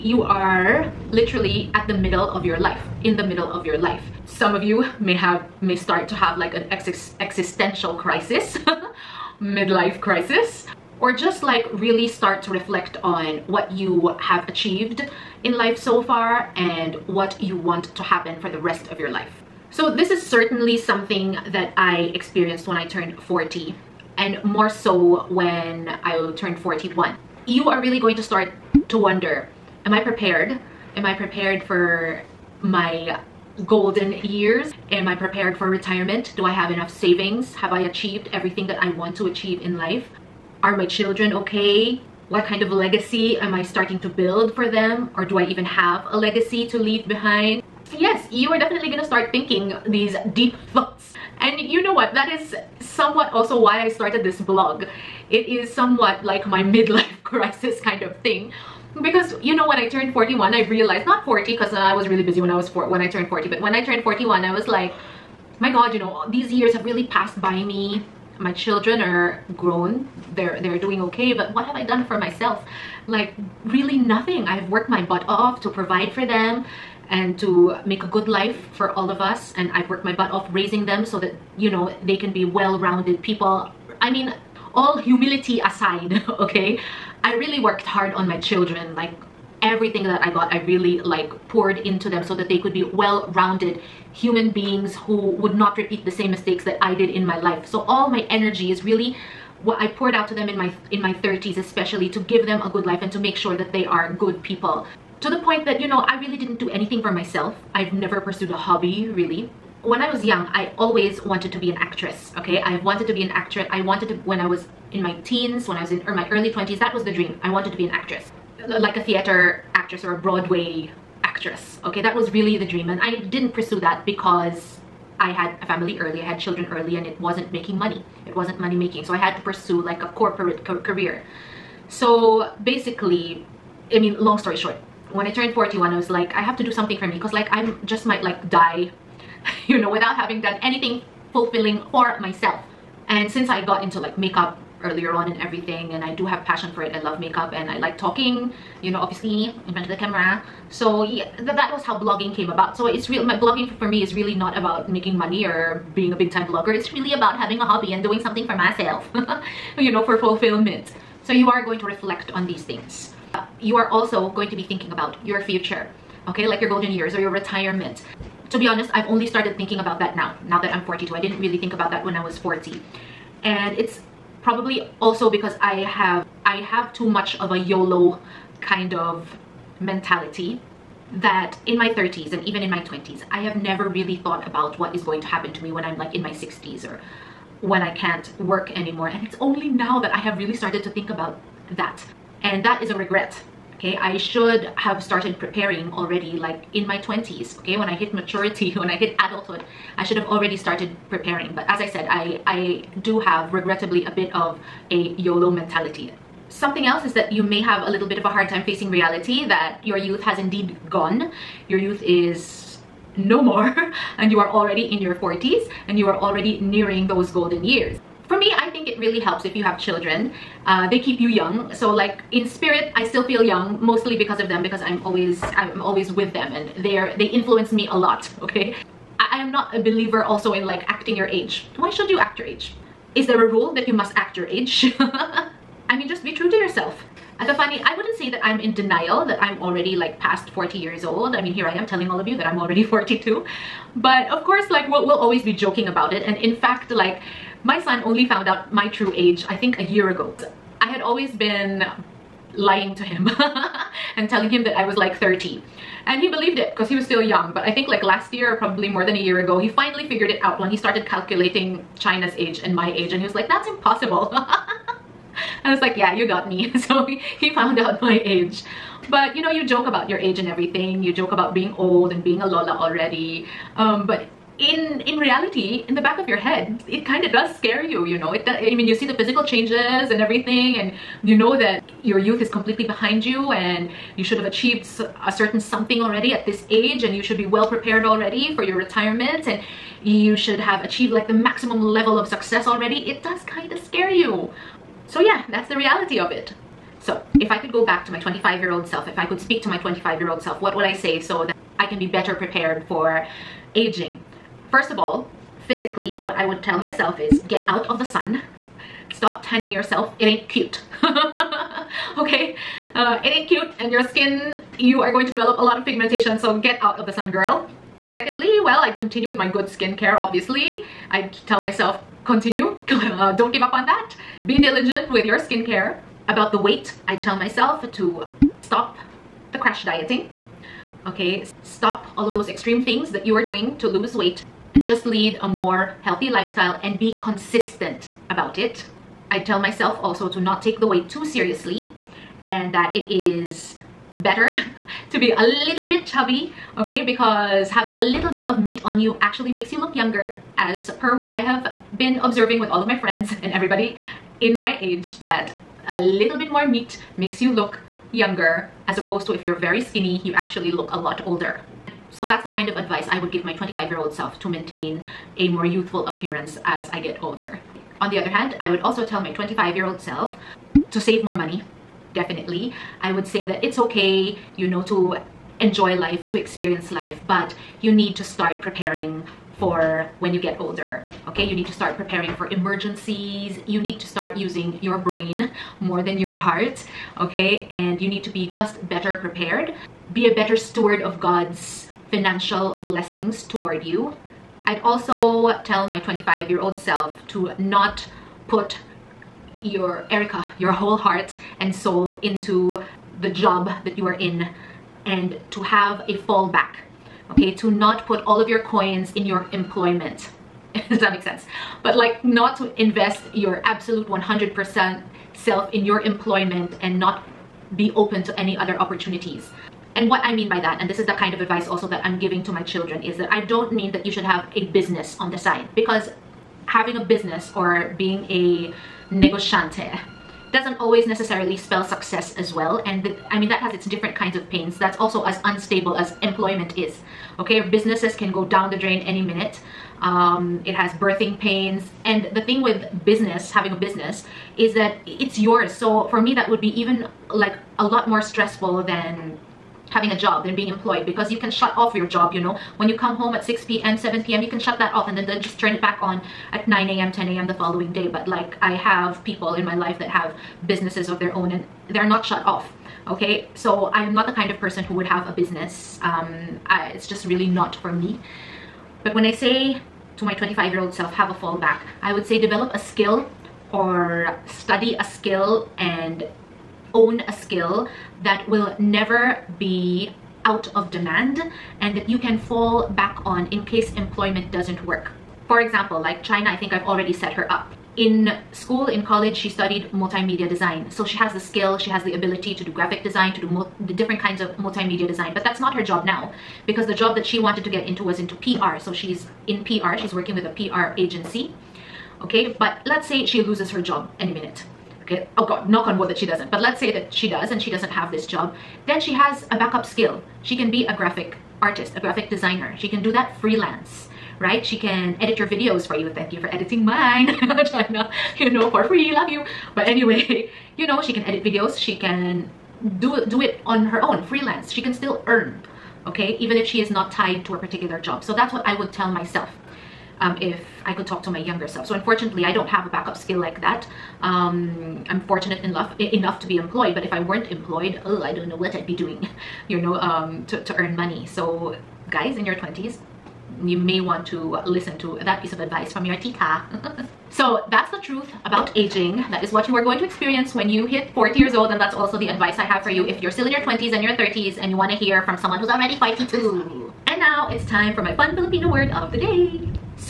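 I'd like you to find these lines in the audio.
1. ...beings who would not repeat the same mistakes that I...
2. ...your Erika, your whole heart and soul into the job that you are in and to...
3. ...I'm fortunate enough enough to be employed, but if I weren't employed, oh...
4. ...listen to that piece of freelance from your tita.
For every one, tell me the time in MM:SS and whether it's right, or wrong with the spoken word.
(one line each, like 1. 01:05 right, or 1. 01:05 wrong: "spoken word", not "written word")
1. 01:34 right
2. 06:39 right
3. 08:55 right
4. 09:04 wrong: "advice", not "freelance".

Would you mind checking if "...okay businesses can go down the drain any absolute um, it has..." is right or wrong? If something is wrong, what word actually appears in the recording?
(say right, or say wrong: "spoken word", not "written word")
wrong: "minute", not "absolute".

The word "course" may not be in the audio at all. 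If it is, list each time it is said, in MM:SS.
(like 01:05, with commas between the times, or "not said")
04:04.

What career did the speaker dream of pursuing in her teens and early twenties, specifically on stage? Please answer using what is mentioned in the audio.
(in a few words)
Broadway actress.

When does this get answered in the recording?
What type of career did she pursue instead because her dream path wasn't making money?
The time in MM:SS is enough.
02:10.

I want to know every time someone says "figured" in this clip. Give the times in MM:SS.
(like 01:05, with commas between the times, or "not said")
04:20.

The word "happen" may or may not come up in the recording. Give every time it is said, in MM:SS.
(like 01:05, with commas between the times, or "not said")
00:18, 03:05.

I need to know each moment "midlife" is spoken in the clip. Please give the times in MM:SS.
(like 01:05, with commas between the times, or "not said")
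00:09, 00:56.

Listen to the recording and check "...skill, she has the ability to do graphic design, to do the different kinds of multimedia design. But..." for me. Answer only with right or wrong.
right.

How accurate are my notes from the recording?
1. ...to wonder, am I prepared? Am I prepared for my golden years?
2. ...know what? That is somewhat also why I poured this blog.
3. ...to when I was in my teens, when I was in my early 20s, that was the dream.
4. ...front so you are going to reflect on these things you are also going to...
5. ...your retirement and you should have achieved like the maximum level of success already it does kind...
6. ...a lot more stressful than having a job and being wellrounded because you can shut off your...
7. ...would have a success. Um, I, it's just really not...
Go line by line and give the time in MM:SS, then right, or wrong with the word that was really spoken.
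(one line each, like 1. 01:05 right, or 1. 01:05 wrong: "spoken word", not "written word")
1. 00:28 right
2. 00:51 wrong: "started", not "poured"
3. 01:54 right
4. 02:40 wrong: "fulfillment", not "front"
5. 04:48 right
6. 07:27 wrong: "employed", not "wellrounded"
7. 07:44 wrong: "business", not "success".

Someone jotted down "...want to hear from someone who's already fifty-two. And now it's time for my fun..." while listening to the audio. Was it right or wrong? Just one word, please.
right.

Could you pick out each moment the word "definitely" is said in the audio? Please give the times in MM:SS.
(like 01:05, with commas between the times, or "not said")
00:48, 06:12.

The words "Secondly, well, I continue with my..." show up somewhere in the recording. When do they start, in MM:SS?
05:18.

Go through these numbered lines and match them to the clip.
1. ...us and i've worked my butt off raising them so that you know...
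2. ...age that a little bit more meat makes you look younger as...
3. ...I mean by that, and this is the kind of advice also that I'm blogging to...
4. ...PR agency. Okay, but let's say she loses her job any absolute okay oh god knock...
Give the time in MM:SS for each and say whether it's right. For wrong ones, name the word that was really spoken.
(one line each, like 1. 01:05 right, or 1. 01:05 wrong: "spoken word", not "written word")
1. 01:19 right
2. 05:54 right
3. 07:00 wrong: "giving", not "blogging"
4. 08:20 wrong: "minute", not "absolute".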